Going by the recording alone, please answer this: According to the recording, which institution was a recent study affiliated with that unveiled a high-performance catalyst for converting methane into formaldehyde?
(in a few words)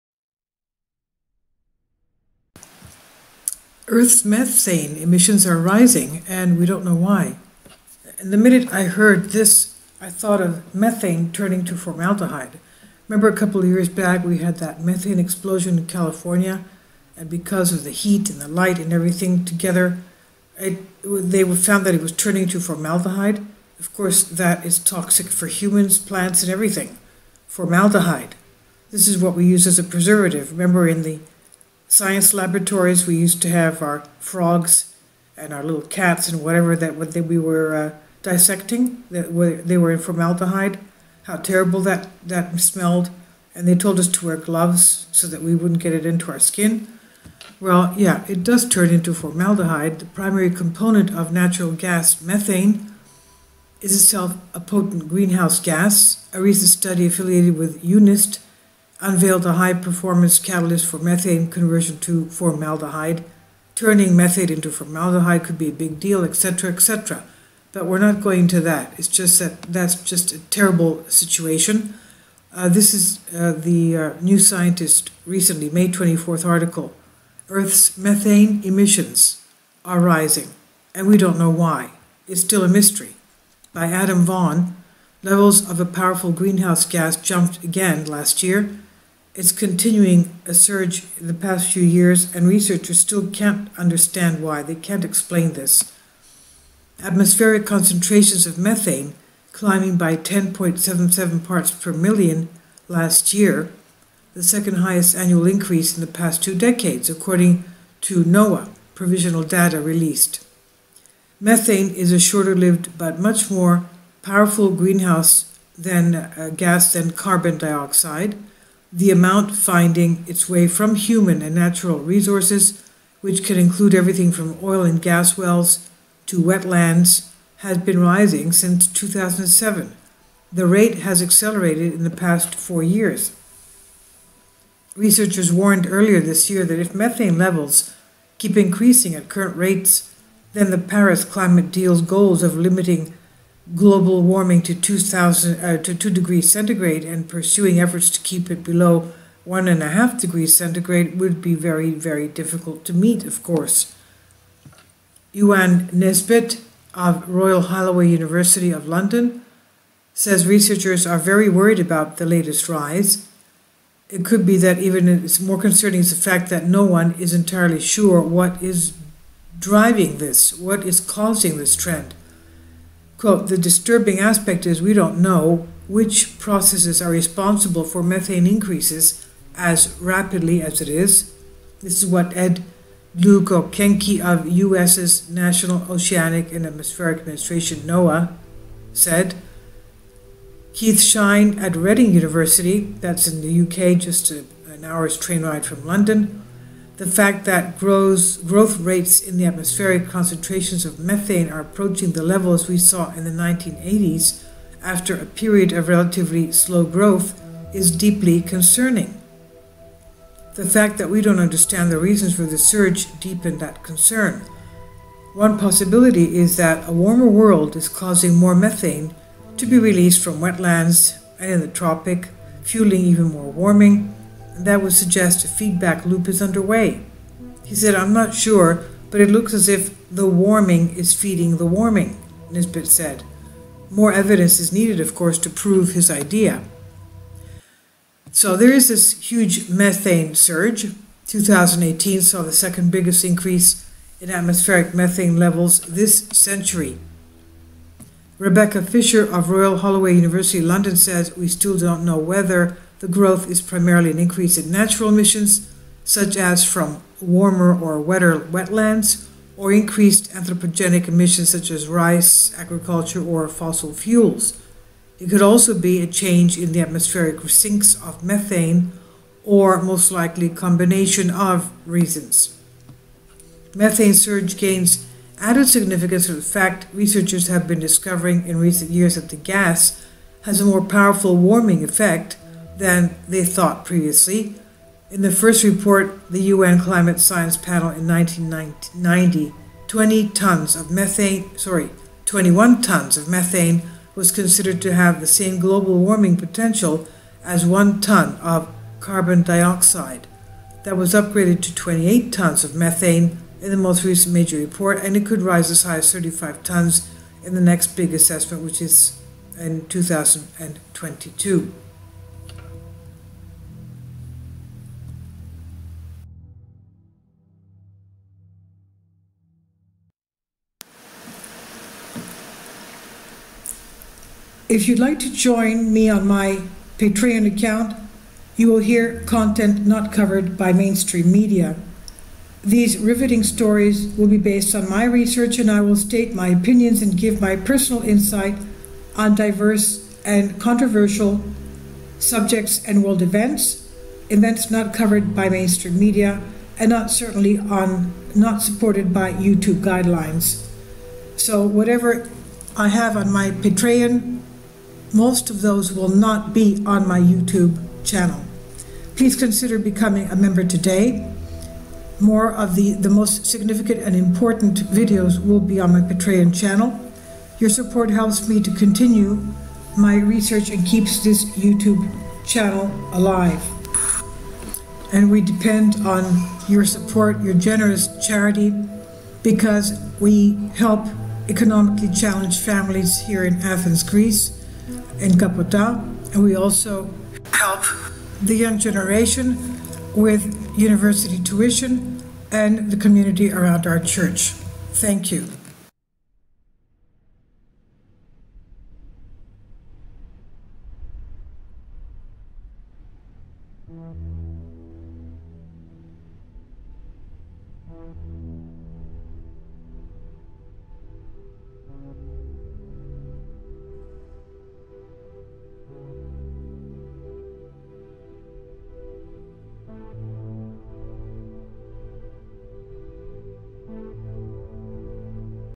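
UNIST.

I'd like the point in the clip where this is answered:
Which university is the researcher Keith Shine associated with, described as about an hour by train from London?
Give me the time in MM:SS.
03:11.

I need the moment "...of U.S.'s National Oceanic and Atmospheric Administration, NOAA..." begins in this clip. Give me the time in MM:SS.
03:04.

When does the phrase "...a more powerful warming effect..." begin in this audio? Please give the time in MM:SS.
04:40.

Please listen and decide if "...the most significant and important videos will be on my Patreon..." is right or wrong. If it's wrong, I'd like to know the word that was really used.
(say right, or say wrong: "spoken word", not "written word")
right.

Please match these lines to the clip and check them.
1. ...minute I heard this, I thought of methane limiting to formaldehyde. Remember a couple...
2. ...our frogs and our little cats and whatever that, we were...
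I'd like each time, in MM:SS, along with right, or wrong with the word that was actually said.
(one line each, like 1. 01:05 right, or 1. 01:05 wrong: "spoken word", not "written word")
1. 00:08 wrong: "turning", not "limiting"
2. 00:33 right.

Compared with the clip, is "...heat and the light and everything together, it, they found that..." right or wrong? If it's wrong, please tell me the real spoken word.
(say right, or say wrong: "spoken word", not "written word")
right.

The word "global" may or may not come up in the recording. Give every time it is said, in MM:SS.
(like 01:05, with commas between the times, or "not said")
02:23, 04:55.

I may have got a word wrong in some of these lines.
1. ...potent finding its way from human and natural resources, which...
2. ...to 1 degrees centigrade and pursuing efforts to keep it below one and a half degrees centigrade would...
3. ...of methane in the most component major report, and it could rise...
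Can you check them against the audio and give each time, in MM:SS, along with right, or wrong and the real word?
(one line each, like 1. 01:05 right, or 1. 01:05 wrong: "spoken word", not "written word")
1. 01:59 wrong: "amount", not "potent"
2. 02:25 wrong: "2", not "1"
3. 05:02 wrong: "recent", not "component".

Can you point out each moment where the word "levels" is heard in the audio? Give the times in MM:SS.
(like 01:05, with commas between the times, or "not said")
01:25, 02:17, 03:22, 04:05.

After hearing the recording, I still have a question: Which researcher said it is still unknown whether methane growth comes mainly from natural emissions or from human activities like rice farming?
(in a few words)
Rebecca Fisher.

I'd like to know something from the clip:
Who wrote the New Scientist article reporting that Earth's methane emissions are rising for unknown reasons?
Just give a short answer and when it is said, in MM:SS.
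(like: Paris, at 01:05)
Adam Vaughan, at 01:23.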